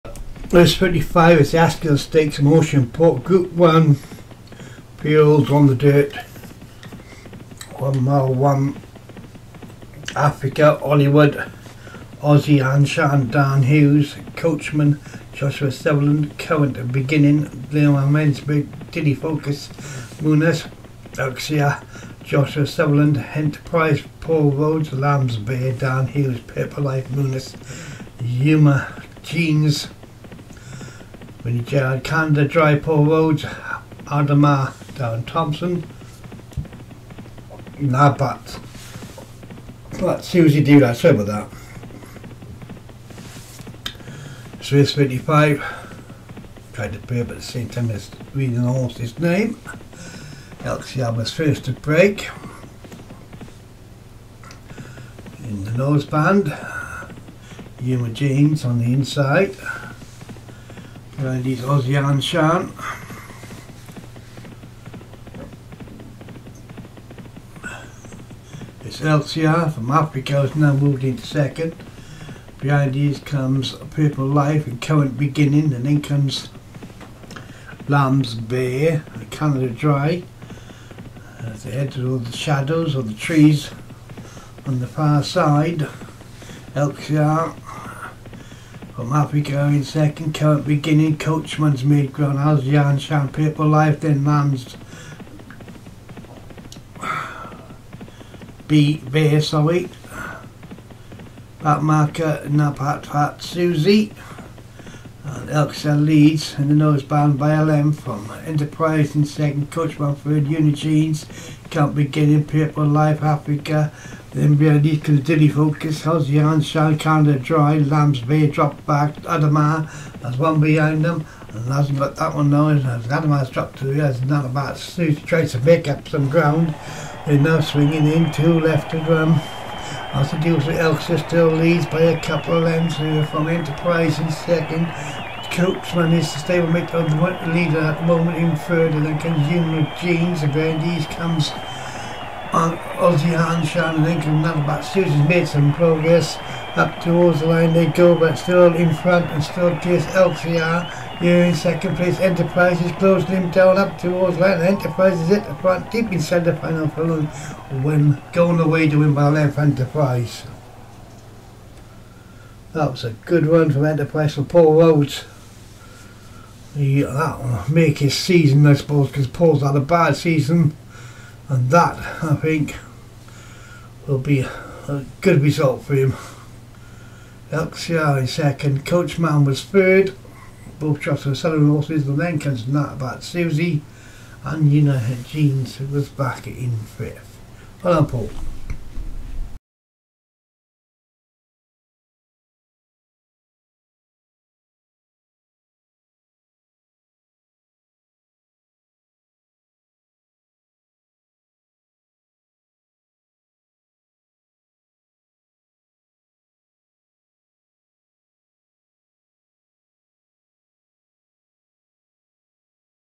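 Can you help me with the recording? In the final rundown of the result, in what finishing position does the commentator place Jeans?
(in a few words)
fifth.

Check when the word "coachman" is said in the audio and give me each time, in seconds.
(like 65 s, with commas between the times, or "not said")
14 s, 91 s, 109 s, 135 s, 178 s.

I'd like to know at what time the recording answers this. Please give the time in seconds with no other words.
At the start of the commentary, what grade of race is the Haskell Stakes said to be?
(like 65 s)
3 s.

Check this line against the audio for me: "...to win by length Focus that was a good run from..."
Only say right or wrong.
wrong.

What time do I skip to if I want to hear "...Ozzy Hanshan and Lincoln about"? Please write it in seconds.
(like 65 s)
142 s.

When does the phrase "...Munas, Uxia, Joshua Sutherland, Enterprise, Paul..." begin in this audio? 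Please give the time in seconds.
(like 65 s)
20 s.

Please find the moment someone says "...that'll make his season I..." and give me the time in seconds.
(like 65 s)
167 s.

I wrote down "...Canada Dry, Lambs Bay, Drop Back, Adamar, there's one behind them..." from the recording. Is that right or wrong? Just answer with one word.
right.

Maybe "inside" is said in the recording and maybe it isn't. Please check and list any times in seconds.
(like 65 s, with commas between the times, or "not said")
58 s, 156 s.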